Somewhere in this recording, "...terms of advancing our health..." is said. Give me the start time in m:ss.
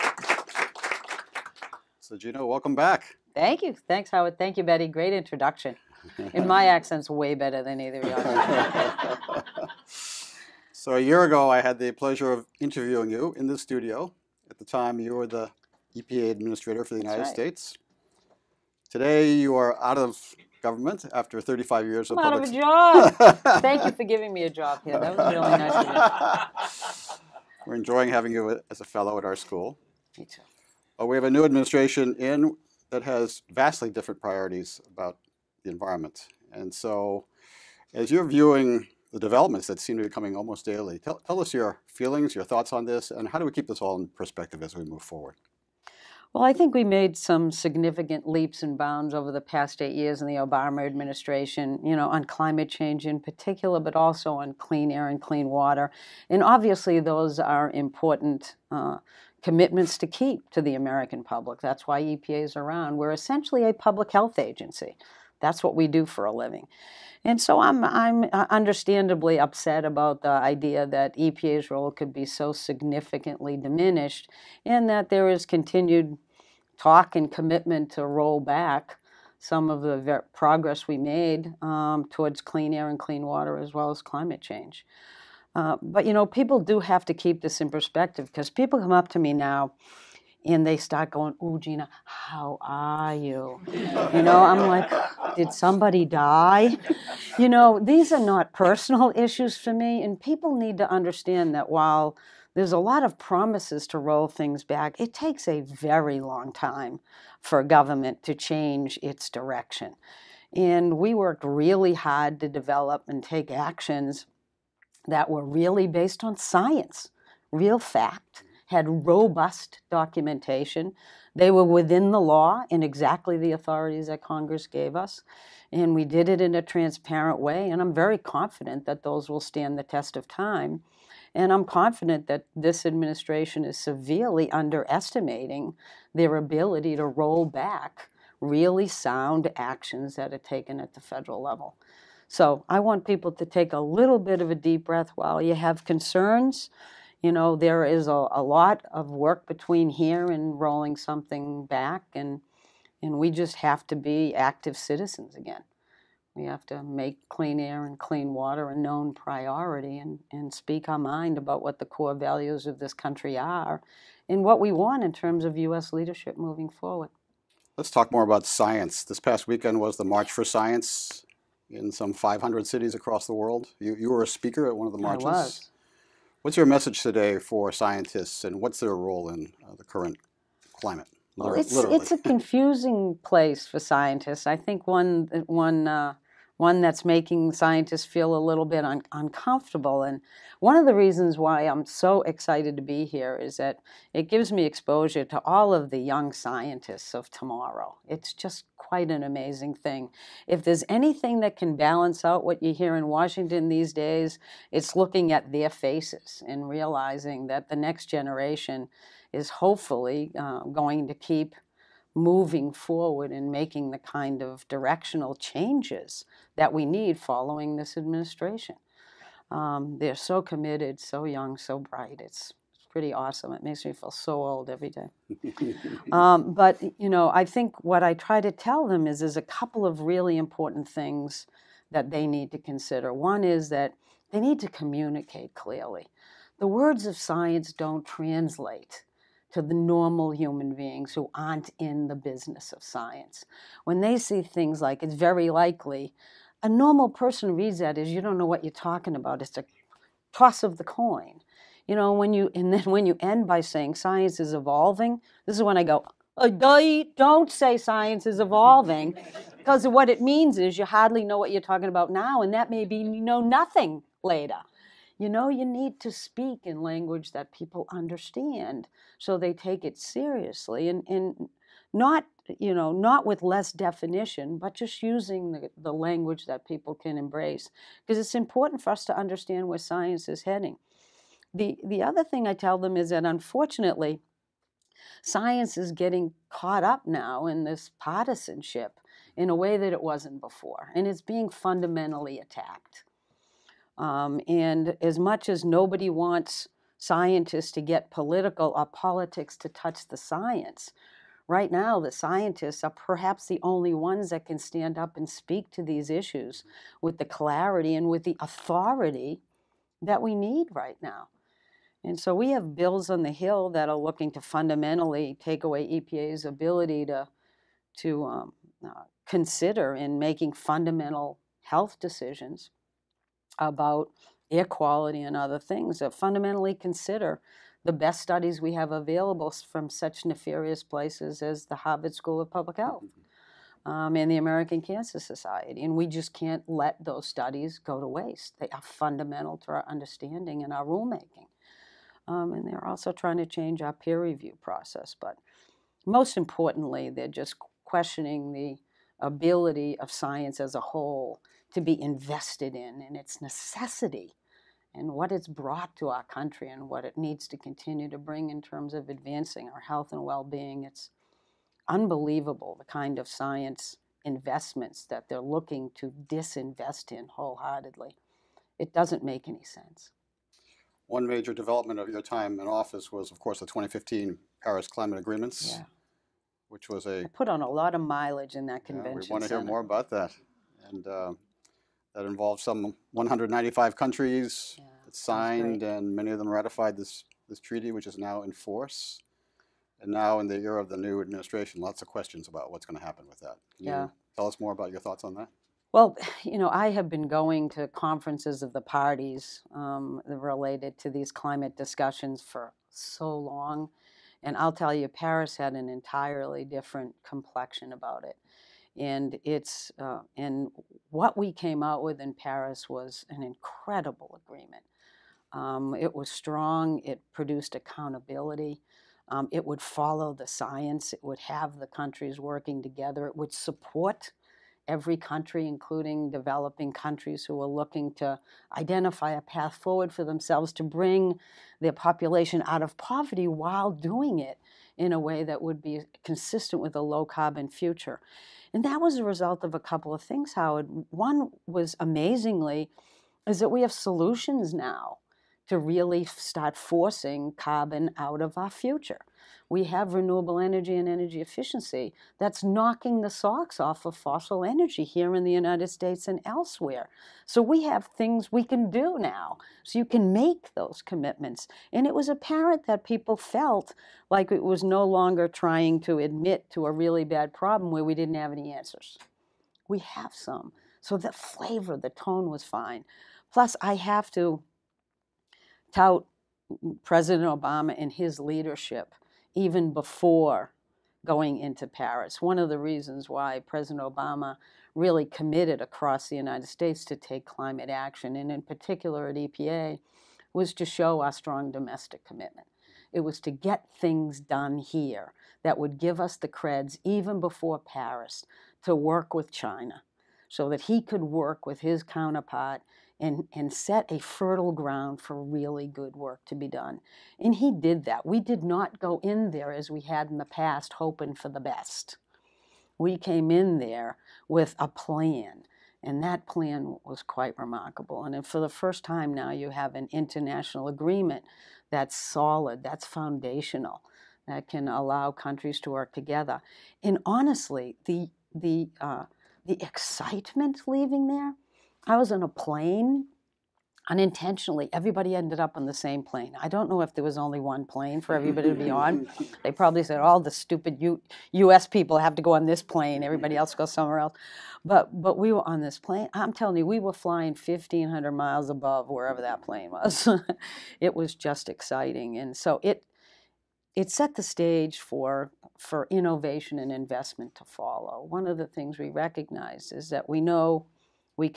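5:58.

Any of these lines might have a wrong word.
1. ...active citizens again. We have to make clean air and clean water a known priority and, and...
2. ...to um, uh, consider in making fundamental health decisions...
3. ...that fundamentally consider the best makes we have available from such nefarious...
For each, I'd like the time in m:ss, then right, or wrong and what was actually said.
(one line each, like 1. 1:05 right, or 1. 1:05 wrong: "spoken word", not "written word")
1. 2:34 right
2. 5:17 right
3. 5:25 wrong: "studies", not "makes".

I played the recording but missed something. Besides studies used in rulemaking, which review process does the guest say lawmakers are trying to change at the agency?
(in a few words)
peer review.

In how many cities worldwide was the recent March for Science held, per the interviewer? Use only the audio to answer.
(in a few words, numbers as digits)
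500.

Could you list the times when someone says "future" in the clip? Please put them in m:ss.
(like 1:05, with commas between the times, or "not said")
7:17, 7:28.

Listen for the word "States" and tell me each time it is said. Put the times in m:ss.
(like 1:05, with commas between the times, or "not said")
0:17, 7:35, 8:06.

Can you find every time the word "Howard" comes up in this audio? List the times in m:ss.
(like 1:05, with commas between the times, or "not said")
0:04, 7:20.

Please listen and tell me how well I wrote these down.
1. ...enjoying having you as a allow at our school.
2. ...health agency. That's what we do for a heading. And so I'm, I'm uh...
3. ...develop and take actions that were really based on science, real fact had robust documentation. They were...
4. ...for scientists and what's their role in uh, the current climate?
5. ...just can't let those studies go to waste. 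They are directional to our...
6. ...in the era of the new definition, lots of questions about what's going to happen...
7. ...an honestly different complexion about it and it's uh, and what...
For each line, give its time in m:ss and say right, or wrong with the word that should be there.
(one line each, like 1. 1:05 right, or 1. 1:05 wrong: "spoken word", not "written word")
1. 0:27 wrong: "fellow", not "allow"
2. 1:04 wrong: "living", not "heading"
3. 1:52 right
4. 2:57 right
5. 5:36 wrong: "fundamental", not "directional"
6. 6:30 wrong: "administration", not "definition"
7. 6:45 wrong: "entirely", not "honestly".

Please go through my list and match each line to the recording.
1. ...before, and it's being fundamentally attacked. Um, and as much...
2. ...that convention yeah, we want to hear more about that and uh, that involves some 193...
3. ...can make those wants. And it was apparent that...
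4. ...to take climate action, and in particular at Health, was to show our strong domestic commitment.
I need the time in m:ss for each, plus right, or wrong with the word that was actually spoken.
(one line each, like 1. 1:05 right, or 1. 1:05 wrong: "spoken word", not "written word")
1. 4:50 right
2. 6:18 wrong: "195", not "193"
3. 7:40 wrong: "commitments", not "wants"
4. 8:07 wrong: "EPA", not "Health".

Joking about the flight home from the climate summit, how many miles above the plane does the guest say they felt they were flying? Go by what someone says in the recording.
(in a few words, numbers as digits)
1,500.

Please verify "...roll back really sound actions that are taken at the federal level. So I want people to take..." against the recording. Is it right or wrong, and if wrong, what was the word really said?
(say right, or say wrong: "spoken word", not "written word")
right.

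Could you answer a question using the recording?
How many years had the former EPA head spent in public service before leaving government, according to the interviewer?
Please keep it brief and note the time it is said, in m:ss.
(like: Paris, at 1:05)
35 years, at 0:21.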